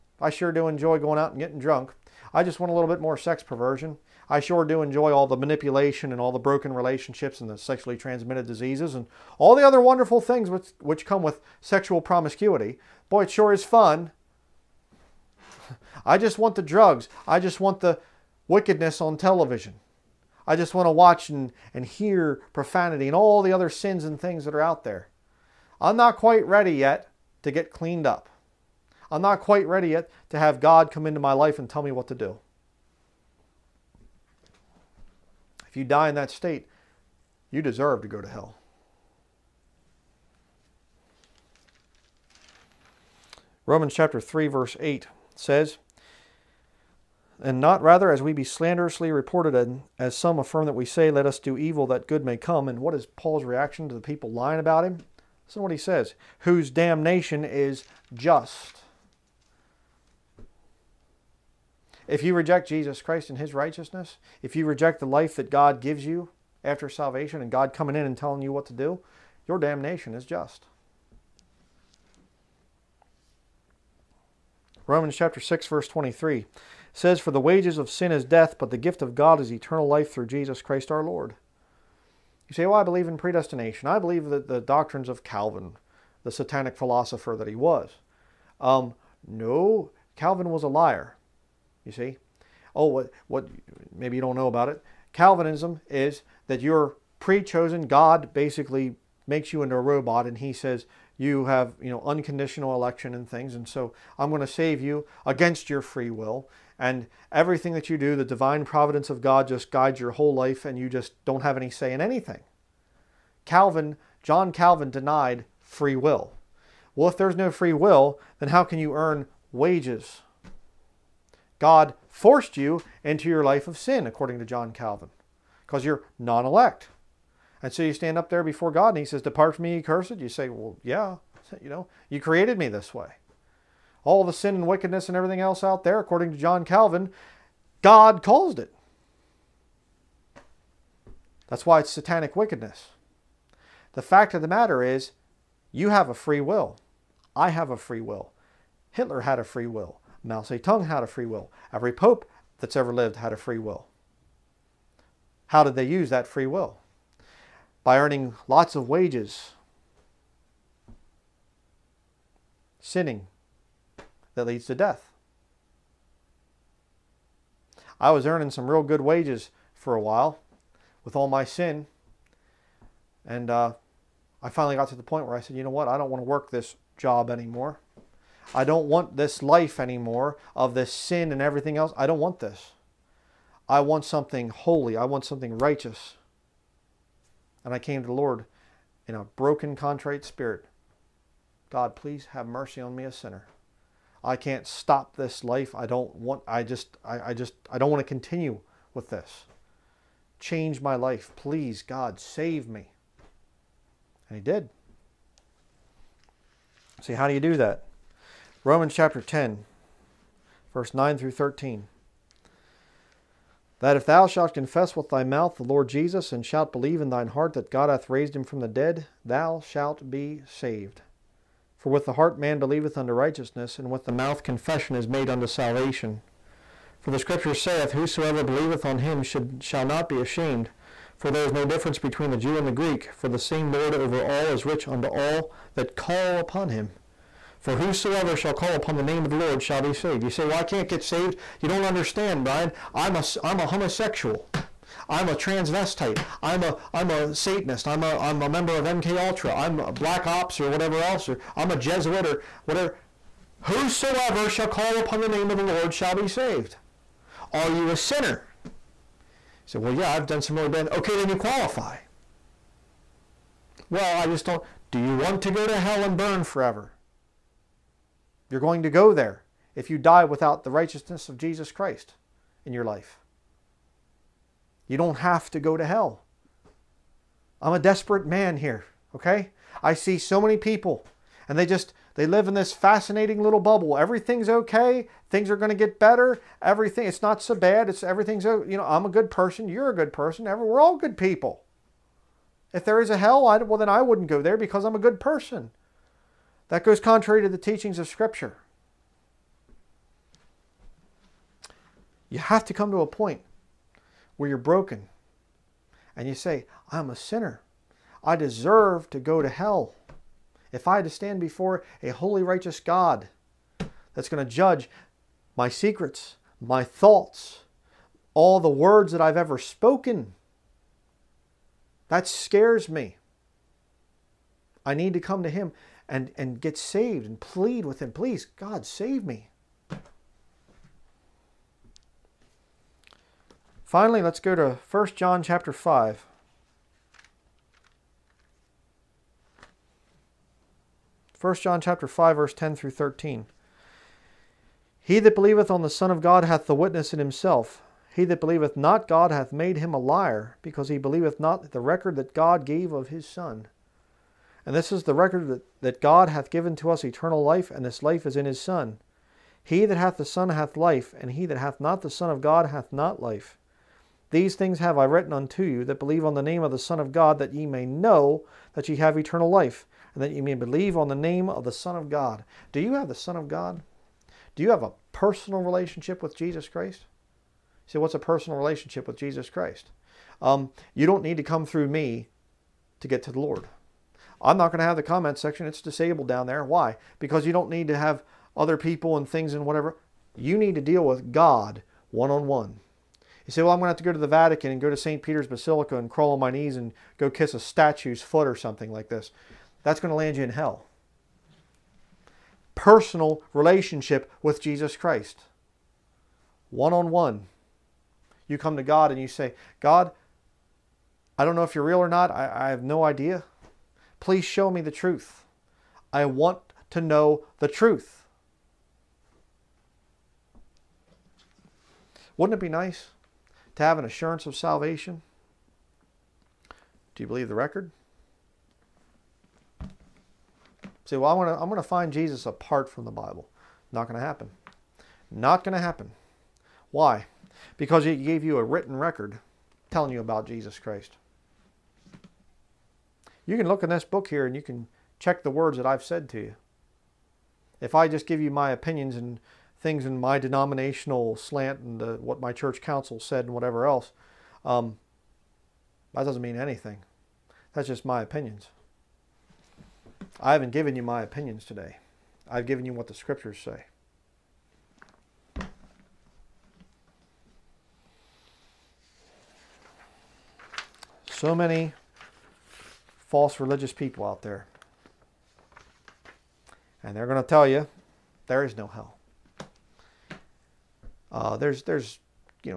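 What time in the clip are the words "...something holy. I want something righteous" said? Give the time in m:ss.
3:04.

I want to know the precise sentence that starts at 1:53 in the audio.
Calvin, John Calvin denied free will.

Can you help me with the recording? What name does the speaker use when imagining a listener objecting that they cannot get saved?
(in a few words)
Bryan.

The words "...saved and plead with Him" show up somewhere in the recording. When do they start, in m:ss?
5:26.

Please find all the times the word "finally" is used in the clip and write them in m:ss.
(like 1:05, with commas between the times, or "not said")
2:54, 5:33.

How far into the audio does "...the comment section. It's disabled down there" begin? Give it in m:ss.
6:24.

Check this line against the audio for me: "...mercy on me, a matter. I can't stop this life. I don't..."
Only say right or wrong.
wrong.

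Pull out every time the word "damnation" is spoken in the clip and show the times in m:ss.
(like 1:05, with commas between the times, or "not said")
0:56, 1:09.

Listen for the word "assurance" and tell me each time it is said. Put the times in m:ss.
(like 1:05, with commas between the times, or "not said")
7:04.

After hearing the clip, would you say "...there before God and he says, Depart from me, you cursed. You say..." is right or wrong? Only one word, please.
right.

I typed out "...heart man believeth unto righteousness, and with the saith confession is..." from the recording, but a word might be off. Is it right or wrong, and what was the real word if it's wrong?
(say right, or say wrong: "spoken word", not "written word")
wrong: "mouth", not "saith".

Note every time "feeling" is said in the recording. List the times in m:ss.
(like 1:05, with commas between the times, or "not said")
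not said.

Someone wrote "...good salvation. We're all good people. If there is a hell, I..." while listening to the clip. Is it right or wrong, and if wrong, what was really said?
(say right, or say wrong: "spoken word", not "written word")
wrong: "person", not "salvation".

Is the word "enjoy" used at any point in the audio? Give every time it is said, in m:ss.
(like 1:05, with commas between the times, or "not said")
0:00, 0:04.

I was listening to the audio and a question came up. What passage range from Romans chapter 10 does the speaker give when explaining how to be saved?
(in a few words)
Verses 9 through 13.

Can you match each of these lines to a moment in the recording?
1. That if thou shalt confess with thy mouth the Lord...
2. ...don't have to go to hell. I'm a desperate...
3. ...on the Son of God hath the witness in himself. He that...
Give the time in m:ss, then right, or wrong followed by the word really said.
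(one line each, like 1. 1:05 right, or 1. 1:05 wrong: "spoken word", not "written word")
1. 3:33 right
2. 4:34 right
3. 5:45 right.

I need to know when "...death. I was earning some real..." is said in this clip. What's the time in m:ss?
2:44.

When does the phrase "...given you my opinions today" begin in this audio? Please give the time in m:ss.
7:40.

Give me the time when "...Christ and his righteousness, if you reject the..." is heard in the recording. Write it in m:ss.
1:03.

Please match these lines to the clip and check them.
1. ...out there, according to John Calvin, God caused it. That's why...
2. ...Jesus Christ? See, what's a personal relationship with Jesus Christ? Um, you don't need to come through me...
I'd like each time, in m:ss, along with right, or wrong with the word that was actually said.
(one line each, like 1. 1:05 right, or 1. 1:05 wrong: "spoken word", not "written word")
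1. 2:15 right
2. 6:16 right.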